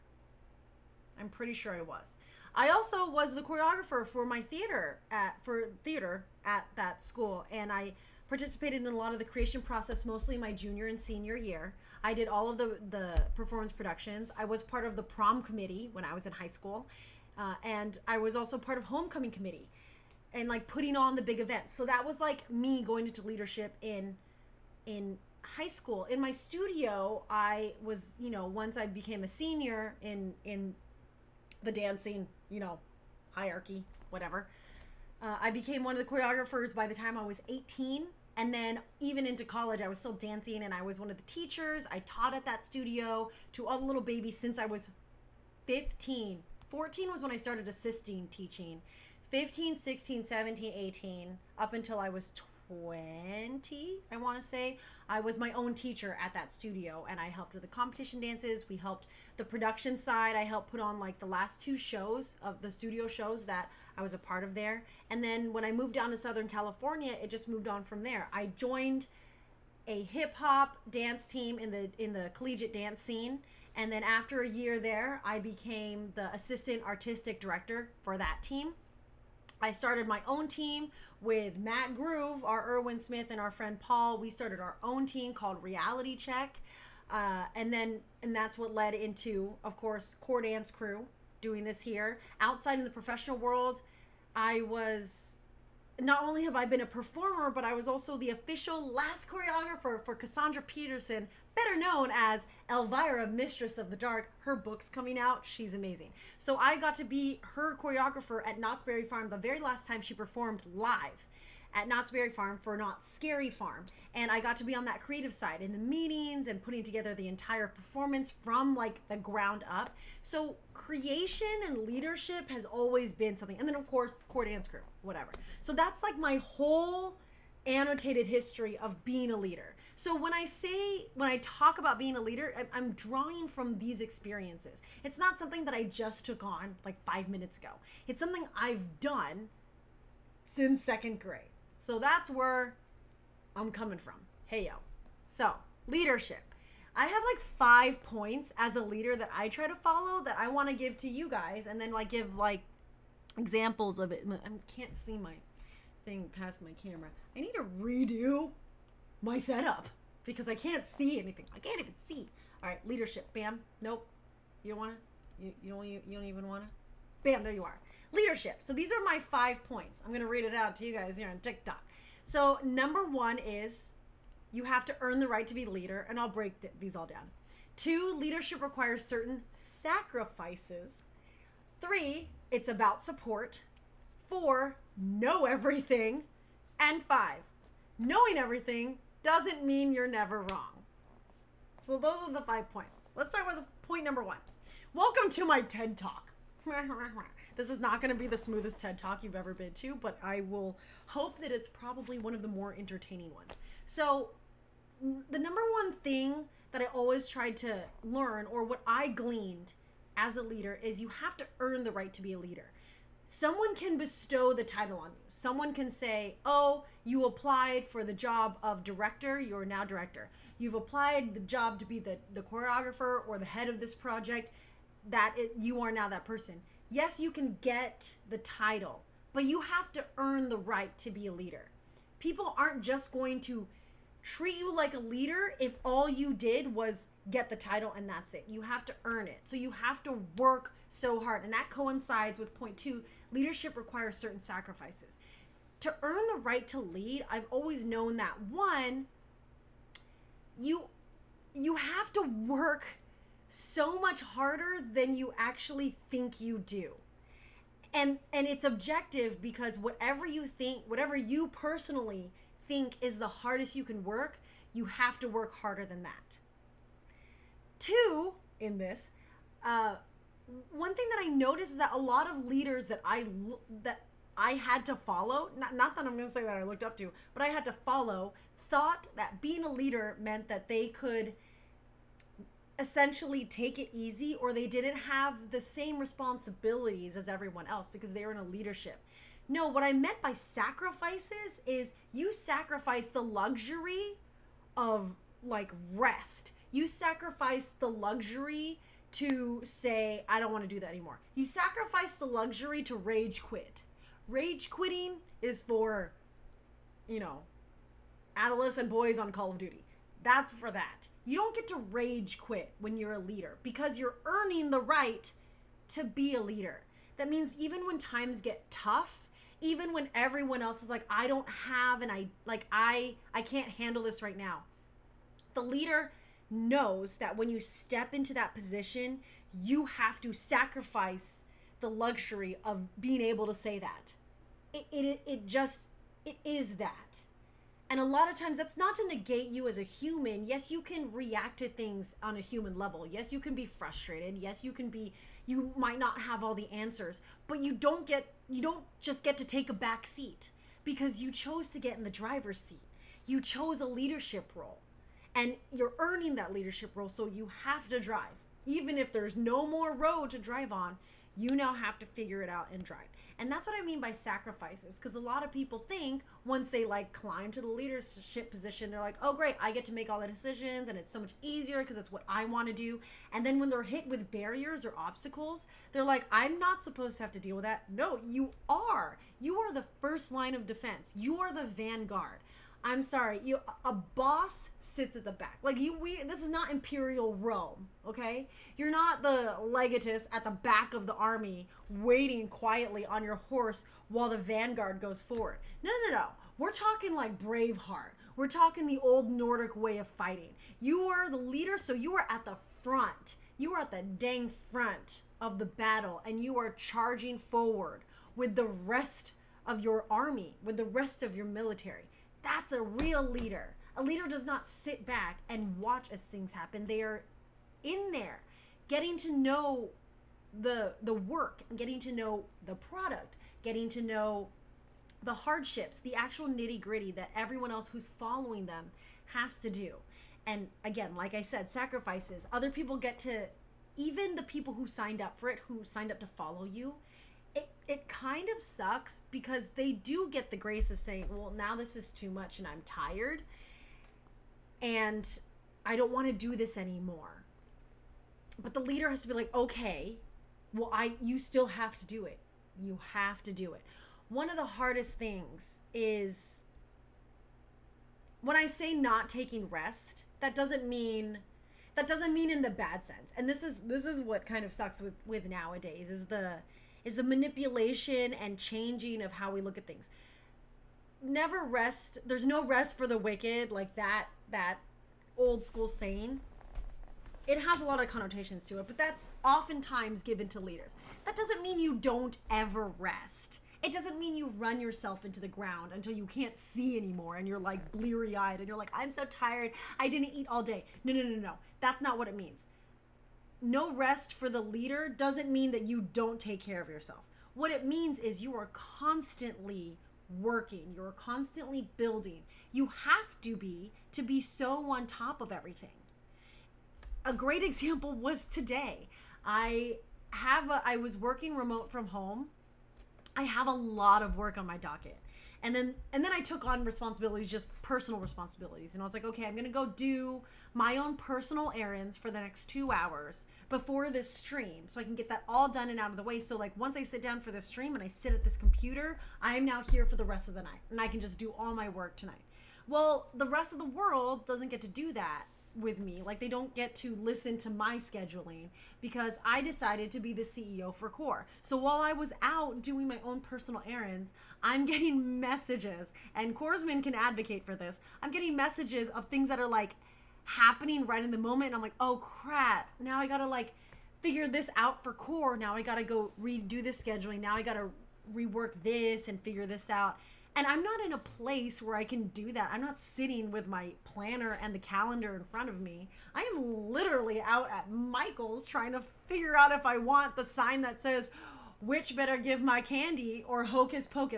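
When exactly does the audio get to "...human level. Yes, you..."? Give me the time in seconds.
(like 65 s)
342 s.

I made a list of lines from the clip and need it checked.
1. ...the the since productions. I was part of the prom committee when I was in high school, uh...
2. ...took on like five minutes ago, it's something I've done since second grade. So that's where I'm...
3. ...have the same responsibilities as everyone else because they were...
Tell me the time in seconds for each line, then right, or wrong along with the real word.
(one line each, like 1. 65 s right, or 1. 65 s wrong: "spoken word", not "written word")
1. 12 s wrong: "performance", not "since"
2. 136 s right
3. 284 s right.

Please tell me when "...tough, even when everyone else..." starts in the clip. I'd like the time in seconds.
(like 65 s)
318 s.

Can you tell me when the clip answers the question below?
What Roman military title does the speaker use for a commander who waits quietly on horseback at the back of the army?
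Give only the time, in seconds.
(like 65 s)
389 s.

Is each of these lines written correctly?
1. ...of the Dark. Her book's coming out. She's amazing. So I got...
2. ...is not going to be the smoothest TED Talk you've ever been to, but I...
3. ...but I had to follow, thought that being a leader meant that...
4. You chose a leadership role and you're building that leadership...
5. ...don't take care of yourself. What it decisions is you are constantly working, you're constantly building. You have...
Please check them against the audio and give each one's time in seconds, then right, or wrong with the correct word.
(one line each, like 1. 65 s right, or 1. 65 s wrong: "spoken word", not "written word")
1. 103 s right
2. 197 s right
3. 277 s right
4. 353 s wrong: "earning", not "building"
5. 496 s wrong: "means", not "decisions".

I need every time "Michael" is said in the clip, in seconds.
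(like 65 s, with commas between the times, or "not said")
567 s.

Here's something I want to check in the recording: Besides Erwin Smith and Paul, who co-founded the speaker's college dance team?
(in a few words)
Matt Groove.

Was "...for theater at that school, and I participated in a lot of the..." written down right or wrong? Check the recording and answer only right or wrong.
right.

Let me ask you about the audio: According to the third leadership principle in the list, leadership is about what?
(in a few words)
Support.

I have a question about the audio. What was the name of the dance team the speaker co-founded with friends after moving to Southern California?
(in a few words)
Reality Check.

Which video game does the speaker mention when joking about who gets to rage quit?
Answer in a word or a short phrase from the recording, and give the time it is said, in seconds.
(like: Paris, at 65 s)
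Call of Duty, at 309 s.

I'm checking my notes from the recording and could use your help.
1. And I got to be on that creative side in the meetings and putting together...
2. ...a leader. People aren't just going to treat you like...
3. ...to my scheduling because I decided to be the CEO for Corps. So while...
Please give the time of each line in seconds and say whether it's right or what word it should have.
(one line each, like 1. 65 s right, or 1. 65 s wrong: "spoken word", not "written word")
1. 114 s right
2. 231 s right
3. 537 s right.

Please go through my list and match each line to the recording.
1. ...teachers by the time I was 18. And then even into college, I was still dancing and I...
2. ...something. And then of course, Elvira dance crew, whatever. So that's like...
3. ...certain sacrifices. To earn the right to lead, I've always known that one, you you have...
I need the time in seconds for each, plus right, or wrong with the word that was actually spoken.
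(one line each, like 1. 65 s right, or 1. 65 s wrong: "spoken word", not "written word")
1. 36 s wrong: "choreographers", not "teachers"
2. 123 s wrong: "Corps", not "Elvira"
3. 244 s right.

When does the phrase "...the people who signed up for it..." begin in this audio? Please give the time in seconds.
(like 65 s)
434 s.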